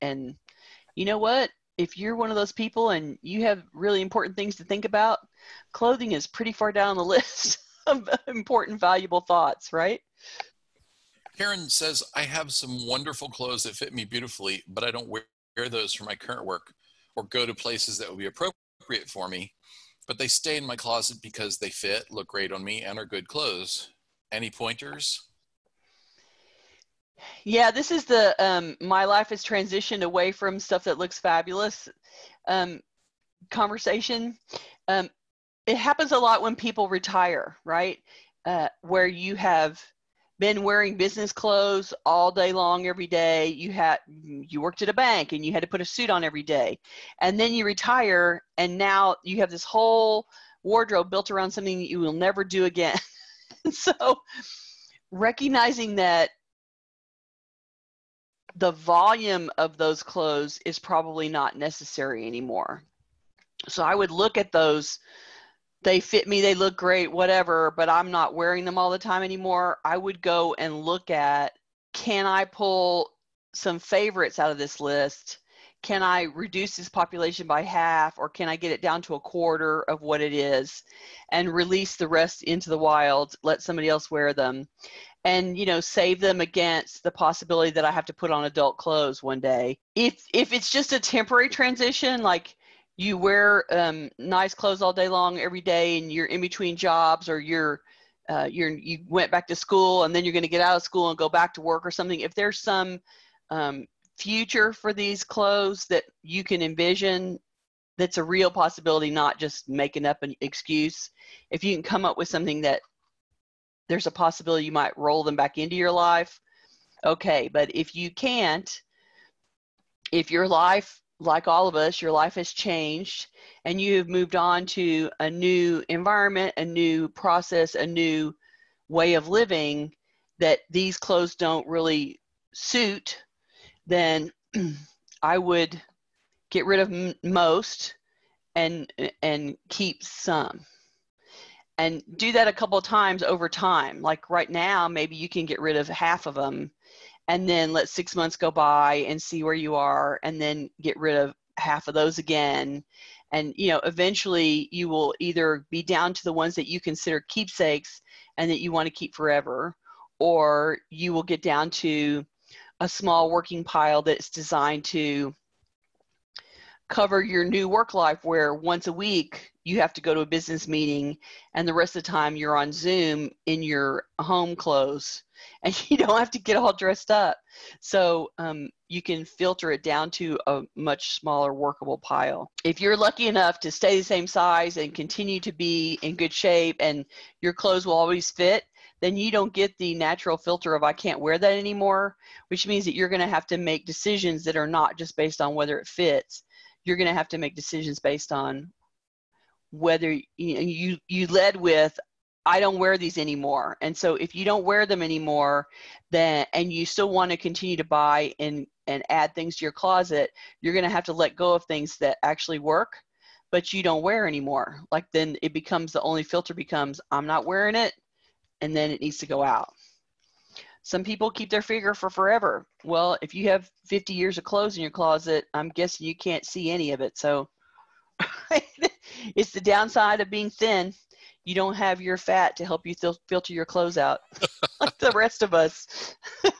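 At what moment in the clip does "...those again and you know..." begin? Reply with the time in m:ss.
2:31.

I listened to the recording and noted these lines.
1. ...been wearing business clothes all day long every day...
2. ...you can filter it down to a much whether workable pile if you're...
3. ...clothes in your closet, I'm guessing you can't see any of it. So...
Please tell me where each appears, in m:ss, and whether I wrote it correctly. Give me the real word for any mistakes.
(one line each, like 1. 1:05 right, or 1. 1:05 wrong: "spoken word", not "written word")
1. 0:40 right
2. 2:58 wrong: "smaller", not "whether"
3. 3:44 right.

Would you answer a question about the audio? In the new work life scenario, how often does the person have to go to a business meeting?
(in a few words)
once a week.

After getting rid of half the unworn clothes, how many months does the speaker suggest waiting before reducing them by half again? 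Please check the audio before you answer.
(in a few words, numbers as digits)
6.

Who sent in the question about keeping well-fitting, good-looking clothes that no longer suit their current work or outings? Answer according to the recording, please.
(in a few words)
Karen.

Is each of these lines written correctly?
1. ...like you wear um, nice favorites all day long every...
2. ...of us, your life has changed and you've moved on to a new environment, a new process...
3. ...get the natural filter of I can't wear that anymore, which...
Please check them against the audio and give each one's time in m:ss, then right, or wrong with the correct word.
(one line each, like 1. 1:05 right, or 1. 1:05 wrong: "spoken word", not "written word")
1. 1:32 wrong: "clothes", not "favorites"
2. 2:01 right
3. 3:09 right.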